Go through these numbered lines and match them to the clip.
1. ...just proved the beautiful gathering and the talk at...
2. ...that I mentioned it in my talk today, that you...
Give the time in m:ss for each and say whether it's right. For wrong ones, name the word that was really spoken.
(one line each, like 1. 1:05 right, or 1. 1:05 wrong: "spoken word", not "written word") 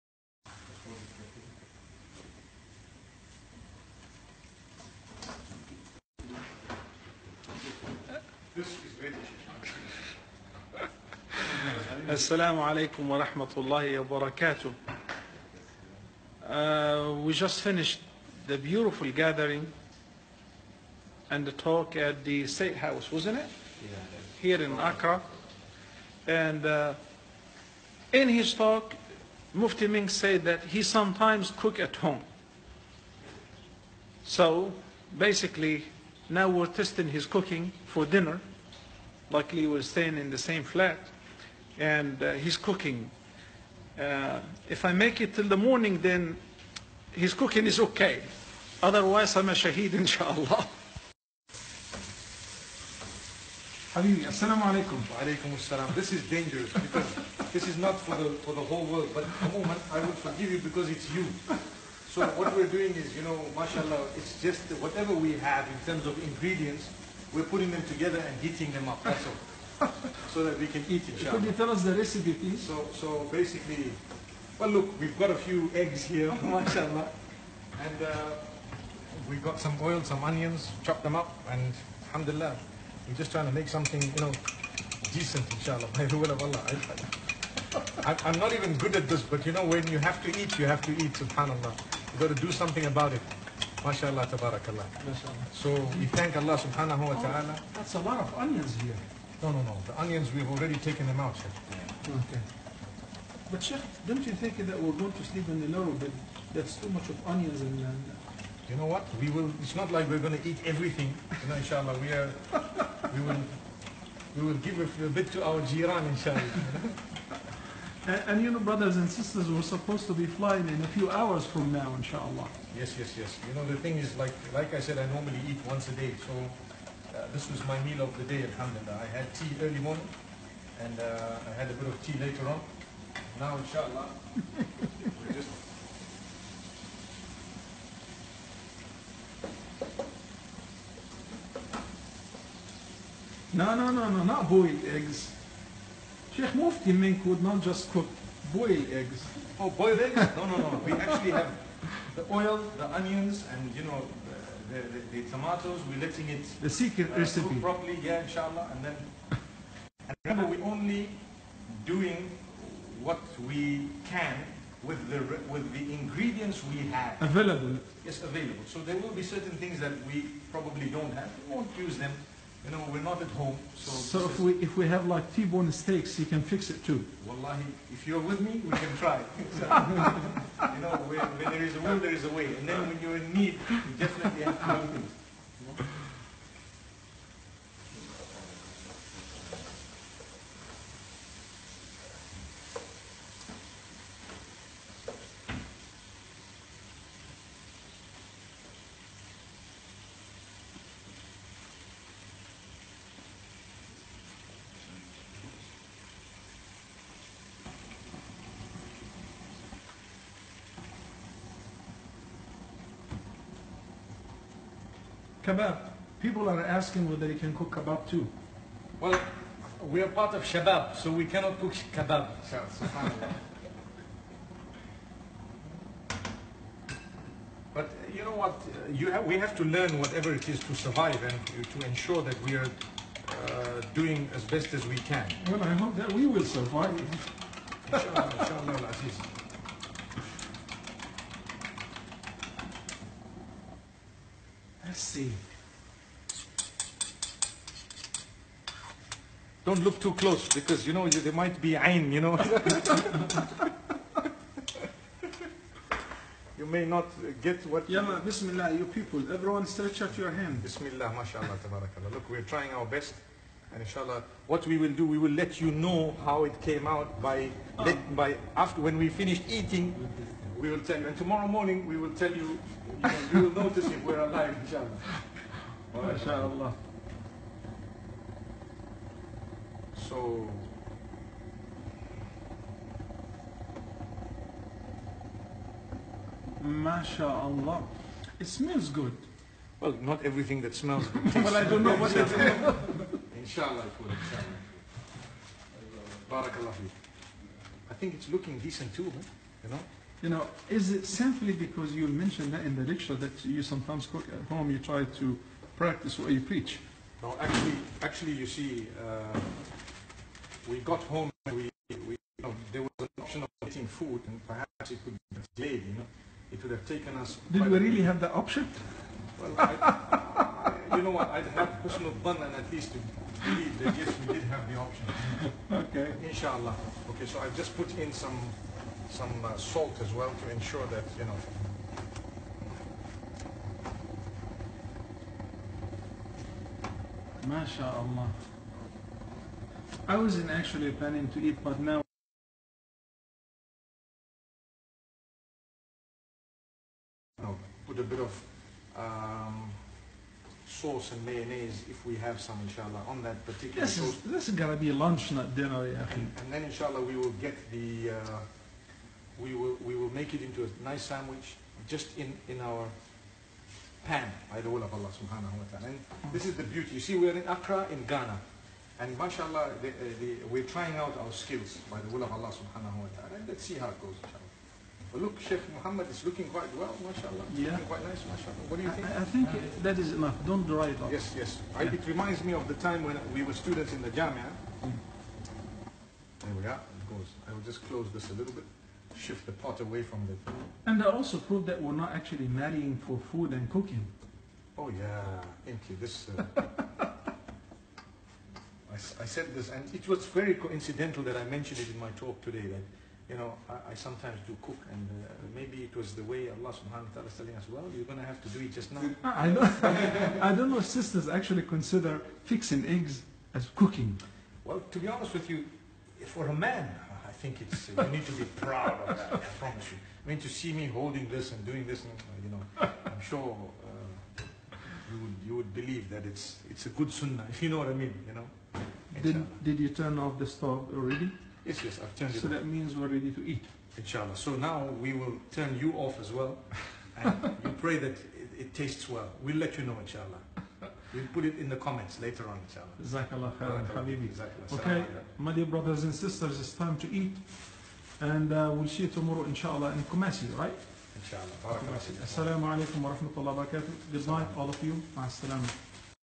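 1. 0:17 wrong: "finished", not "proved"
2. 6:41 right.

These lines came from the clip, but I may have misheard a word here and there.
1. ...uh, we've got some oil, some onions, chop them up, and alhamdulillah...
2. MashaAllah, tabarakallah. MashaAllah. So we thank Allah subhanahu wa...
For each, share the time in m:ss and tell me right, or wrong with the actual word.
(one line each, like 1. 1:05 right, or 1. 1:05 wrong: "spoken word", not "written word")
1. 1:18 right
2. 1:33 right.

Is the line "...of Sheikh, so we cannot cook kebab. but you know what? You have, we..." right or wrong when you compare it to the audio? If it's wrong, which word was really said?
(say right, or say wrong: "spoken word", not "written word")
wrong: "Shabab", not "Sheikh".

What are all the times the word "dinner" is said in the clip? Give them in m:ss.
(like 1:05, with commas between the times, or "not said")
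0:38, 5:55.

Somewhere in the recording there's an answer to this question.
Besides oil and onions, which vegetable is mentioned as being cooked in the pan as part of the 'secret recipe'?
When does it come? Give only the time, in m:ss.
2:35.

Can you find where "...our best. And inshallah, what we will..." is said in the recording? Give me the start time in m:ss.
4:22.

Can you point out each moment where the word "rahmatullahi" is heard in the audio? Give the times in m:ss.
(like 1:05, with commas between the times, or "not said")
0:13, 7:33.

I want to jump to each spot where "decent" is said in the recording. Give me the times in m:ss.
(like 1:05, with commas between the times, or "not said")
1:25, 4:58.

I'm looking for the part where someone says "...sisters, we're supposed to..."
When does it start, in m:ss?
1:59.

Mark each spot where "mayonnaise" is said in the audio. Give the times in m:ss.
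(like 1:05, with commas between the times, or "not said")
5:51.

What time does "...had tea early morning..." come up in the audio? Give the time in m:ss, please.
2:09.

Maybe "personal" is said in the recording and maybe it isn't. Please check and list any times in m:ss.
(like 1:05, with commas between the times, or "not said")
5:21.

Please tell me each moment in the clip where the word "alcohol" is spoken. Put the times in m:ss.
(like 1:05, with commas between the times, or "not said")
not said.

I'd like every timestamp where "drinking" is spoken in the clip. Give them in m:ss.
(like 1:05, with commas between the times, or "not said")
not said.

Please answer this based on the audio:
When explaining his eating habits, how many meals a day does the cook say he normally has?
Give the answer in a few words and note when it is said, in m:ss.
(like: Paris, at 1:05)
Once a day, at 2:05.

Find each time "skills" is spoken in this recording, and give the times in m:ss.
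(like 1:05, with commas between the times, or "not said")
6:11.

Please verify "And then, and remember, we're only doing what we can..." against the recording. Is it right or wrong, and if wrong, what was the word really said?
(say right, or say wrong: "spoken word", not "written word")
right.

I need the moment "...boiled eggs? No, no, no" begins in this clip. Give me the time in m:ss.
2:29.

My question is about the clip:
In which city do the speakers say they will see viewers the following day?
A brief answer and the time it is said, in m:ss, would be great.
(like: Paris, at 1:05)
Kumasi, at 7:30.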